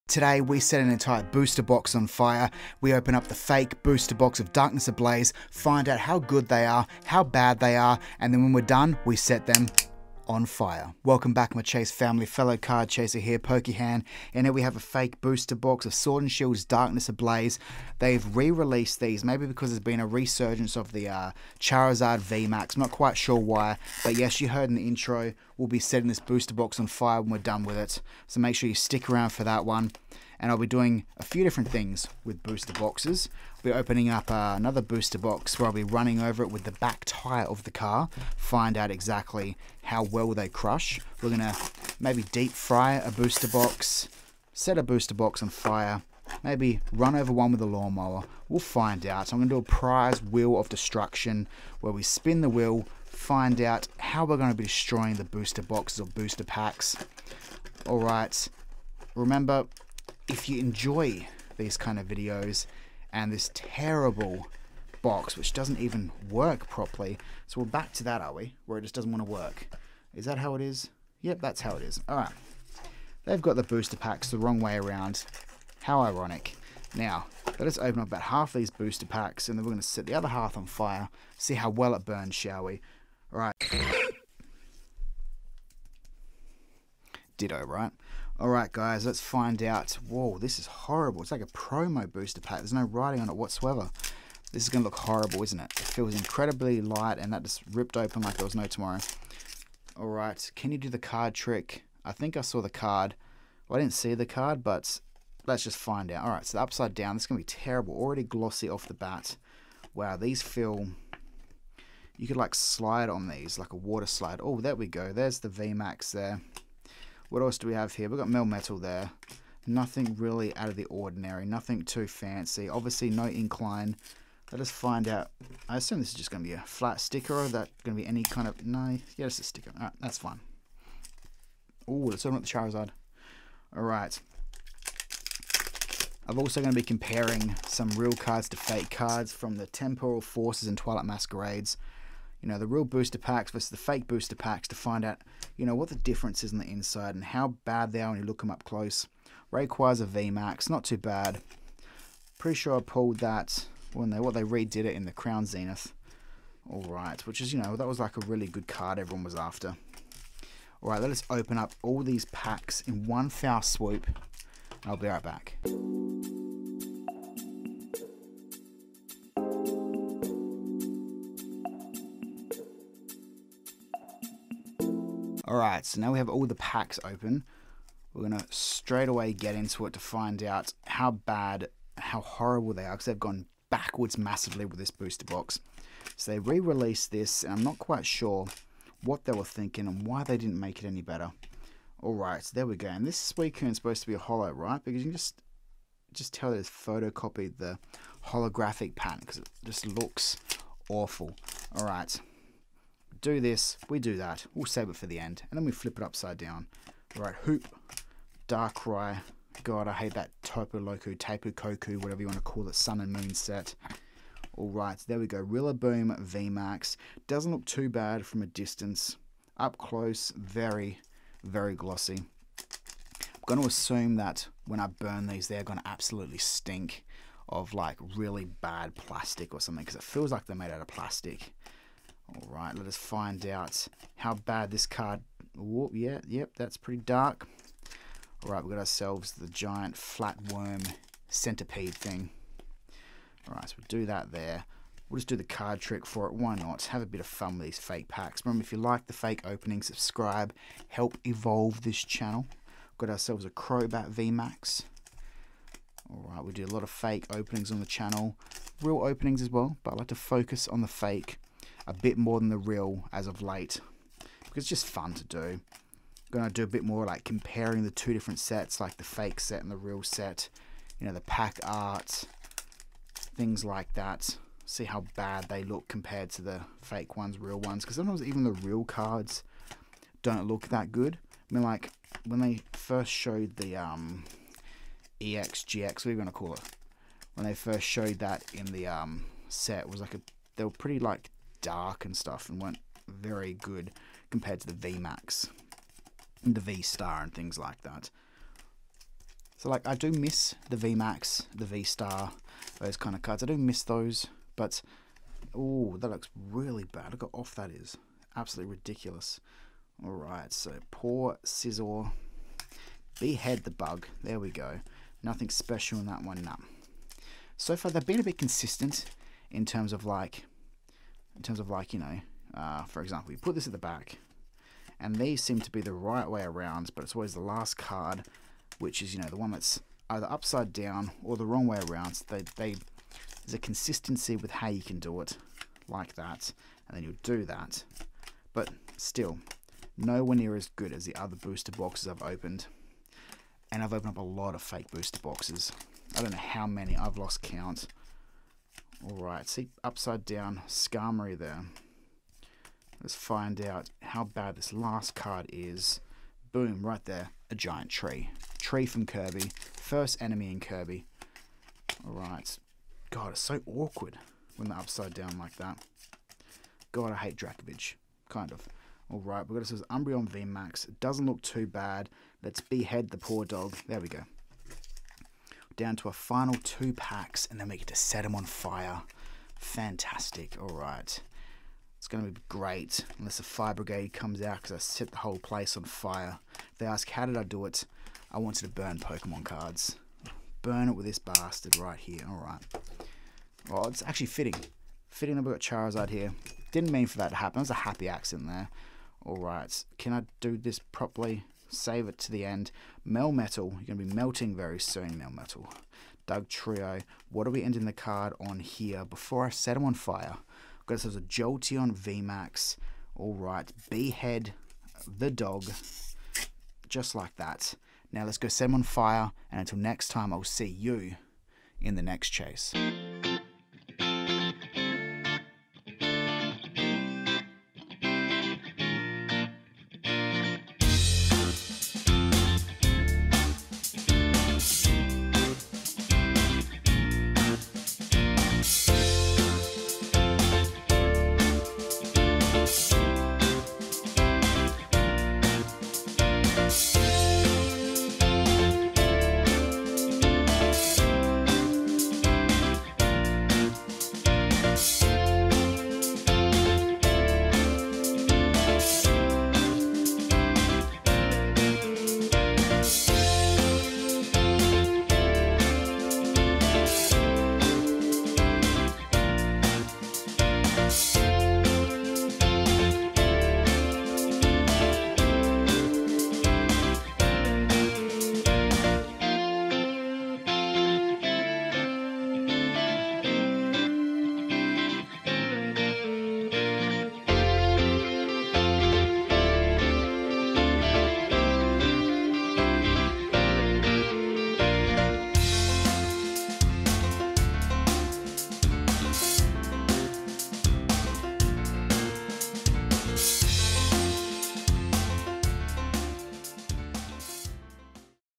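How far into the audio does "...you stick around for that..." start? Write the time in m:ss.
0:28.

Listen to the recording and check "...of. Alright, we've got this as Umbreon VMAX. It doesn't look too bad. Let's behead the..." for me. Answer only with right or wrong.
right.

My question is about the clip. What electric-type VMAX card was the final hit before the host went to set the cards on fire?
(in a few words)
Jolteon VMAX.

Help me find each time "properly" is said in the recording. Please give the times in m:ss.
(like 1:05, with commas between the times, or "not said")
1:06, 6:40.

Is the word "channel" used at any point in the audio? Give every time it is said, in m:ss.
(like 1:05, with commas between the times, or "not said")
4:12, 4:17.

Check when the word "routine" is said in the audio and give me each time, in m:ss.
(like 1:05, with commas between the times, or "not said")
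not said.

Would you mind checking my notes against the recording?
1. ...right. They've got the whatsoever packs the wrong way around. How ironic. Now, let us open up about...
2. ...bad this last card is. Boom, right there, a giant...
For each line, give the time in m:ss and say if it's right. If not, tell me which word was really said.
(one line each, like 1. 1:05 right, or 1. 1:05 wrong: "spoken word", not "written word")
1. 1:12 wrong: "booster", not "whatsoever"
2. 5:54 right.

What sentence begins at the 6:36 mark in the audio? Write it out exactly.
Didn't mean for that to happen.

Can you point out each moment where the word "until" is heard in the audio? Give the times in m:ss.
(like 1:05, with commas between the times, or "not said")
6:59.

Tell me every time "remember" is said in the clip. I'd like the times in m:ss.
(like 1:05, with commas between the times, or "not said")
0:59, 4:08.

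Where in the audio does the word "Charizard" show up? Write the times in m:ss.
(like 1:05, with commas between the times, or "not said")
0:21, 2:12, 6:35.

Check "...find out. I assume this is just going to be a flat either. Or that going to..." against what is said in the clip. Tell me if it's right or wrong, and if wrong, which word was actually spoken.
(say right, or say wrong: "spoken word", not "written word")
wrong: "sticker", not "either".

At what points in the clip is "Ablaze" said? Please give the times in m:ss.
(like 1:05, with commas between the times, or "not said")
0:04, 0:17.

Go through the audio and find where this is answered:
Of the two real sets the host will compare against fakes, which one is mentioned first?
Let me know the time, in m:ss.
2:19.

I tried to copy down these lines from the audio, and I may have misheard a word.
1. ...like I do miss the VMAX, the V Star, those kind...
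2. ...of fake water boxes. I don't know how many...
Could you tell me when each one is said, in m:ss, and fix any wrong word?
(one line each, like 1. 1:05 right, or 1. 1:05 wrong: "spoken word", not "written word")
1. 4:59 right
2. 5:44 wrong: "booster", not "water".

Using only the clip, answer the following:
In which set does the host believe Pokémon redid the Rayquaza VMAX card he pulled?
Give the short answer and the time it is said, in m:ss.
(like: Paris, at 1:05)
Crown Zenith, at 2:35.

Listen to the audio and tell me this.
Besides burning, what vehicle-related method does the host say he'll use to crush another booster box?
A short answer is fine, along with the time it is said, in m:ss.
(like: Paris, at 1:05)
back tire of the car, at 0:36.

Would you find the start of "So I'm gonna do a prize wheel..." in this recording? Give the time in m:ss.
0:49.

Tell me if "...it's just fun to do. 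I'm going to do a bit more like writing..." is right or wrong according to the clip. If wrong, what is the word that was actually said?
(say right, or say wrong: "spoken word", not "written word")
wrong: "comparing", not "writing".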